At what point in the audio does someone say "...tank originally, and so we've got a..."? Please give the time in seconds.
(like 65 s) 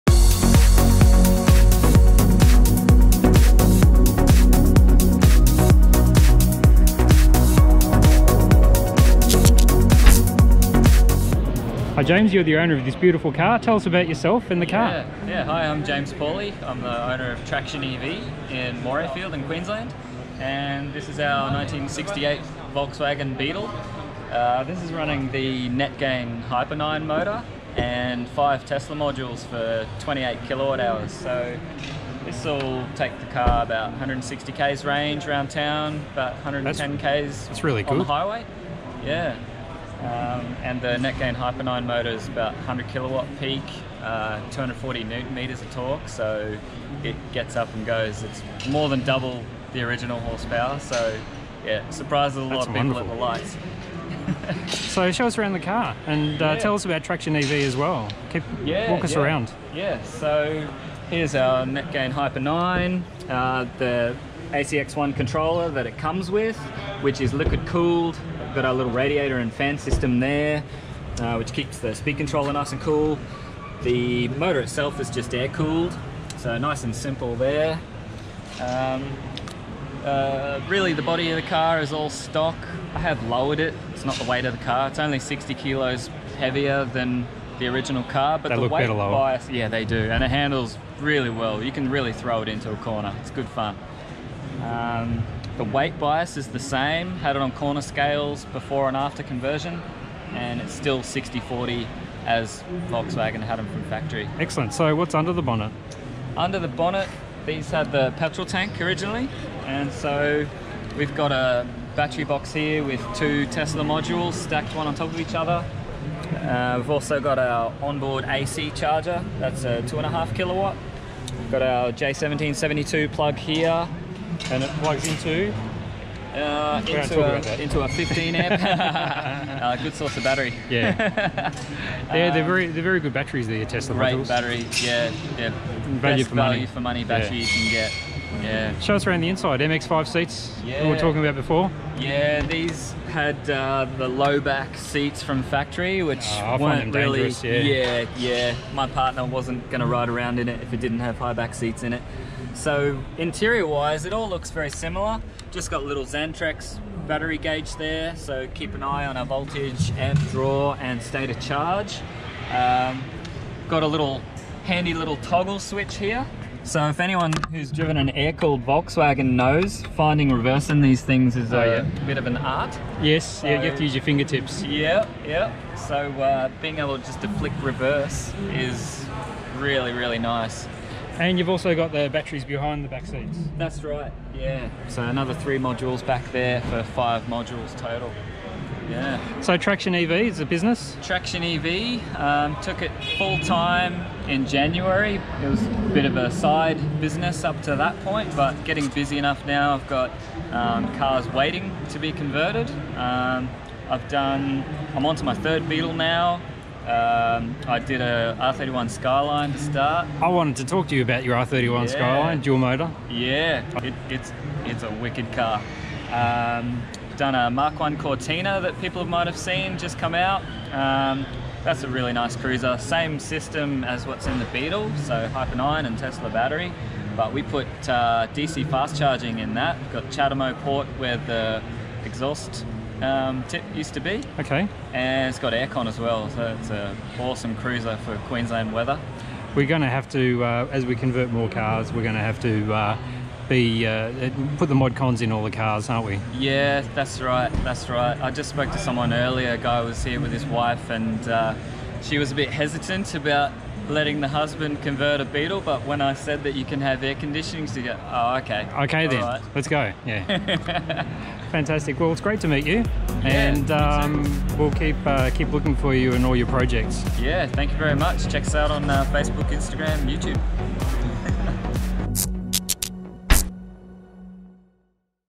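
108 s.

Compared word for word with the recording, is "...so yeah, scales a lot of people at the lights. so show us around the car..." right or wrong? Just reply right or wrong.
wrong.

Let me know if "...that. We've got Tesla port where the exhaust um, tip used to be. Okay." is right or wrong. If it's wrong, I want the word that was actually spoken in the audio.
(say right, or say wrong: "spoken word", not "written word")
wrong: "CHAdeMO", not "Tesla".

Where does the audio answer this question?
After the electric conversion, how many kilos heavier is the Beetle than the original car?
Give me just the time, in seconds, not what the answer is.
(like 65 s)
85 s.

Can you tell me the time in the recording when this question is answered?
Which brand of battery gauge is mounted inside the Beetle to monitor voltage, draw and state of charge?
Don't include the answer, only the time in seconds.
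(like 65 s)
156 s.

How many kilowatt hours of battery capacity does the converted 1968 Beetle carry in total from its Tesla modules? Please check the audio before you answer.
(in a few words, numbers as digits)
28.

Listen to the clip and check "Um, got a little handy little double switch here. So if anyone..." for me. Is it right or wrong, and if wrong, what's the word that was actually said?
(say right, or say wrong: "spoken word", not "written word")
wrong: "toggle", not "double".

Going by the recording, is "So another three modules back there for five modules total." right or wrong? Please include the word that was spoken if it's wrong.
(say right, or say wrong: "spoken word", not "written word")
right.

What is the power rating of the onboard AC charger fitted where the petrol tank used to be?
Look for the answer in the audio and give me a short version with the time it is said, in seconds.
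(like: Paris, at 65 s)
2.5 kilowatts, at 119 s.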